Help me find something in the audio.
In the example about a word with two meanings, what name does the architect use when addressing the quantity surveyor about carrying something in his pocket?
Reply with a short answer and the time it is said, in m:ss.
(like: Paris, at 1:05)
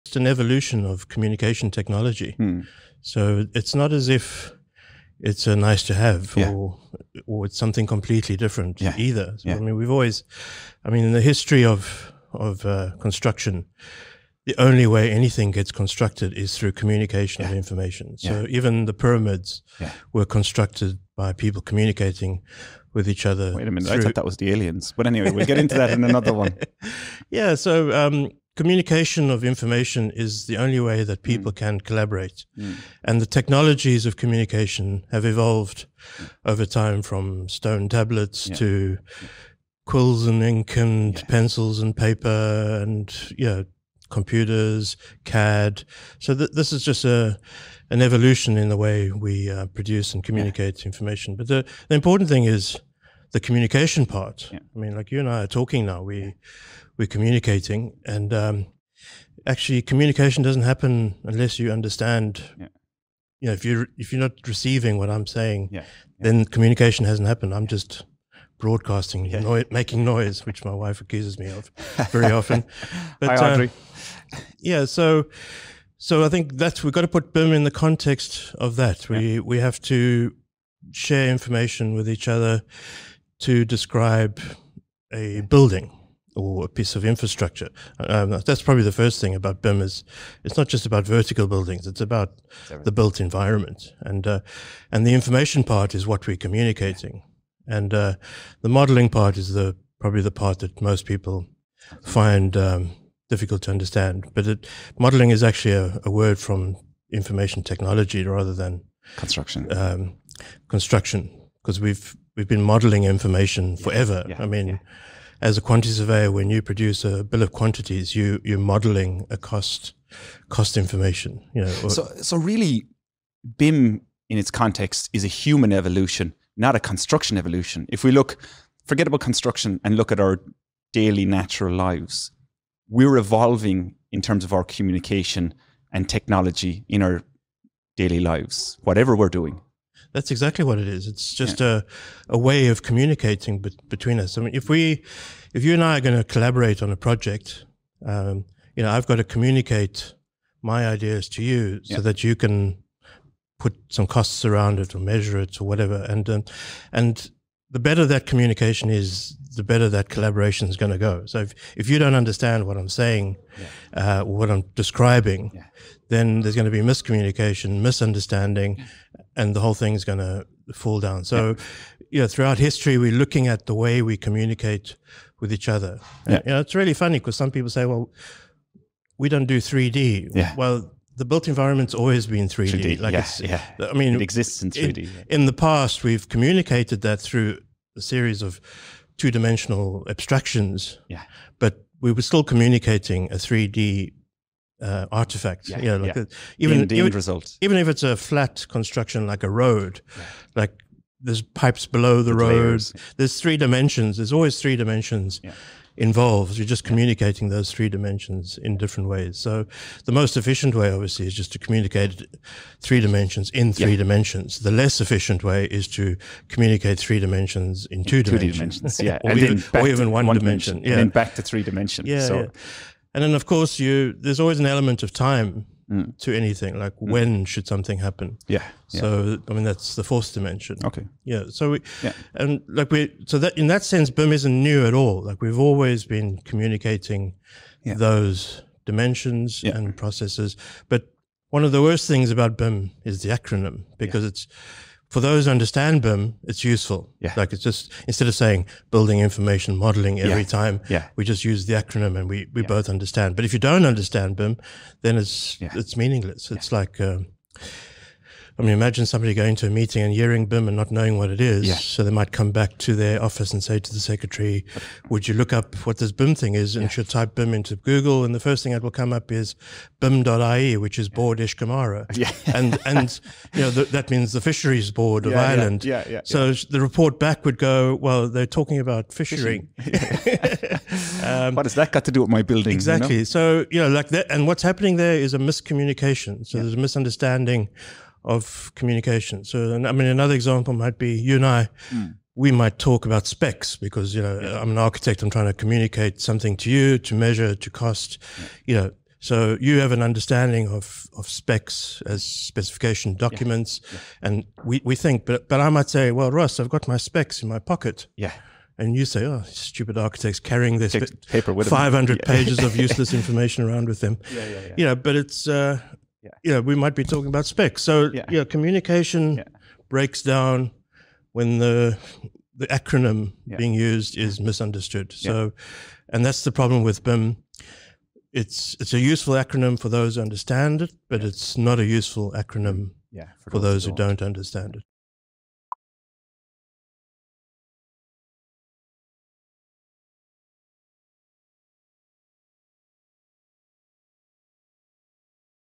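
Ross, at 5:06.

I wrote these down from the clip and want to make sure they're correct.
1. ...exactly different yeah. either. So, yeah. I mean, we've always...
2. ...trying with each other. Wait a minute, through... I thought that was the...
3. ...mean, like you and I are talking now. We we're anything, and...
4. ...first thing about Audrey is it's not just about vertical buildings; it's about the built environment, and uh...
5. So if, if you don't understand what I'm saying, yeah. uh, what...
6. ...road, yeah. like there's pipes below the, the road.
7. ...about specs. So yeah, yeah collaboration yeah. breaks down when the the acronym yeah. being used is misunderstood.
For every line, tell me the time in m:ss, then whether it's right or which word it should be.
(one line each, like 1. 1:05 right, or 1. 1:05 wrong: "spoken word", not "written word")
1. 0:07 wrong: "completely", not "exactly"
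2. 0:21 wrong: "communicating", not "trying"
3. 0:54 wrong: "communicating", not "anything"
4. 1:28 wrong: "BIM", not "Audrey"
5. 2:41 right
6. 3:19 right
7. 5:17 wrong: "communication", not "collaboration".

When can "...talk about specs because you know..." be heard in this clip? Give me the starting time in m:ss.
4:52.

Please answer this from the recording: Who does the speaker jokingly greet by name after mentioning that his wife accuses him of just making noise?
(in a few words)
Audrey.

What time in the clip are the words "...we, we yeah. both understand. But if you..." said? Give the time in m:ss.
4:12.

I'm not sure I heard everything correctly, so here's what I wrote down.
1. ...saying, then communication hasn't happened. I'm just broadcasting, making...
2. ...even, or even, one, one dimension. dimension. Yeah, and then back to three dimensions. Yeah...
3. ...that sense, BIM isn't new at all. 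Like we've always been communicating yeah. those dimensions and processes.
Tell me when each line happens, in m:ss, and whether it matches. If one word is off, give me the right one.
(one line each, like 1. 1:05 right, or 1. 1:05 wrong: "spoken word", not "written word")
1. 1:05 right
2. 3:39 right
3. 3:53 right.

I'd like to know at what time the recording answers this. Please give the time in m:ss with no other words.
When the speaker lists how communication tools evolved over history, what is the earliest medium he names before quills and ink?
0:37.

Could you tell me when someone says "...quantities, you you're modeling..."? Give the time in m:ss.
1:57.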